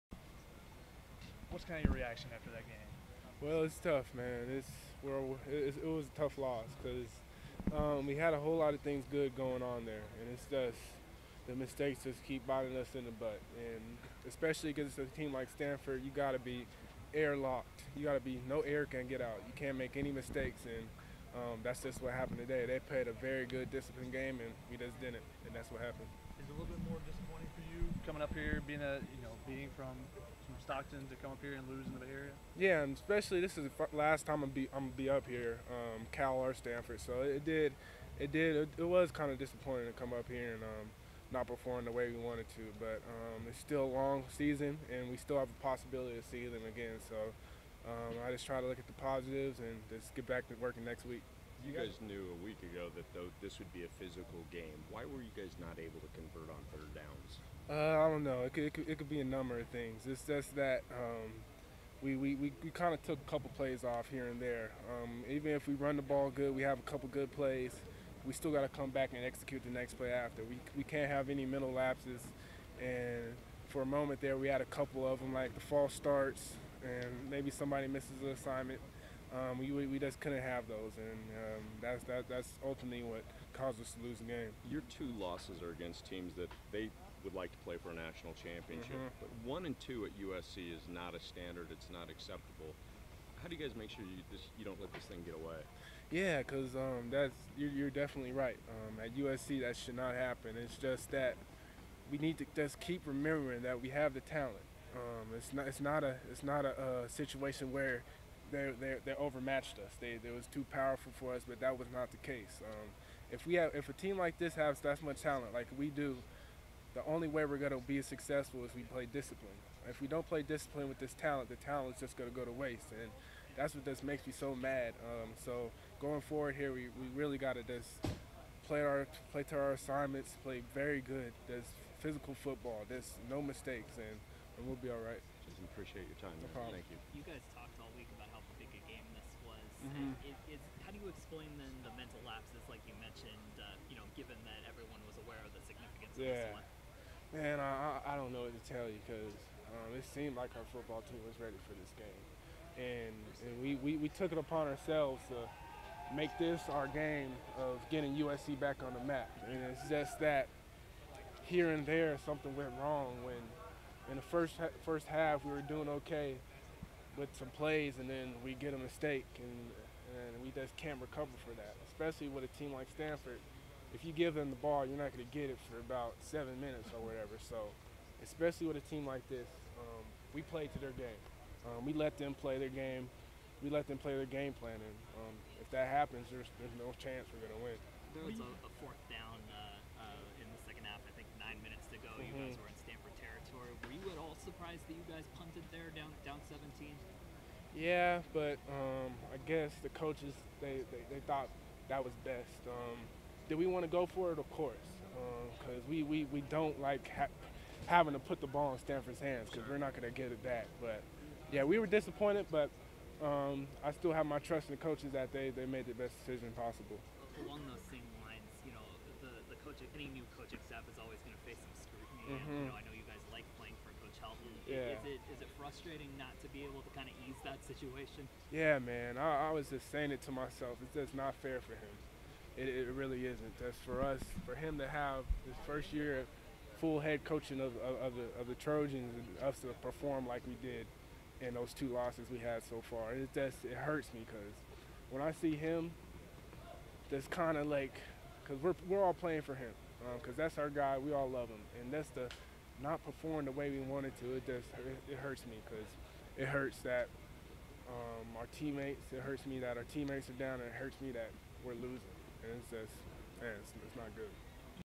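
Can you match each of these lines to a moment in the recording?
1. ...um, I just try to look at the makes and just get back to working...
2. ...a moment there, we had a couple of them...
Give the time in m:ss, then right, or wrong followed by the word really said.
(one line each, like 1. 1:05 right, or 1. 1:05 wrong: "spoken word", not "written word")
1. 0:47 wrong: "positives", not "makes"
2. 1:13 right.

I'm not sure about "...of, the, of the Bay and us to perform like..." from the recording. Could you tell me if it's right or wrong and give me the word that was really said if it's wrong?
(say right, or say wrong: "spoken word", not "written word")
wrong: "Trojans", not "Bay".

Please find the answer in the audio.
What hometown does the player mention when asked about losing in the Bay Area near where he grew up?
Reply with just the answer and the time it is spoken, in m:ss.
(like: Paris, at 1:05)
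Stockton, at 0:30.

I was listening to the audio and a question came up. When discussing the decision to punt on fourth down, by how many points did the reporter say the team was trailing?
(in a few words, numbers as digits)
17.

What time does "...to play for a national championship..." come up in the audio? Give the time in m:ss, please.
1:27.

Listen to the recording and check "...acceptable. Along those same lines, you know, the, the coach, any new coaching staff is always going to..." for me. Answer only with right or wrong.
wrong.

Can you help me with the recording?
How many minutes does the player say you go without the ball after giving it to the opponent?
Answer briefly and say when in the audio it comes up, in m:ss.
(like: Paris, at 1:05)
7, at 2:56.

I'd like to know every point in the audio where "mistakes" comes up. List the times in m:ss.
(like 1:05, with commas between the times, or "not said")
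0:11, 0:20, 2:13, 2:48.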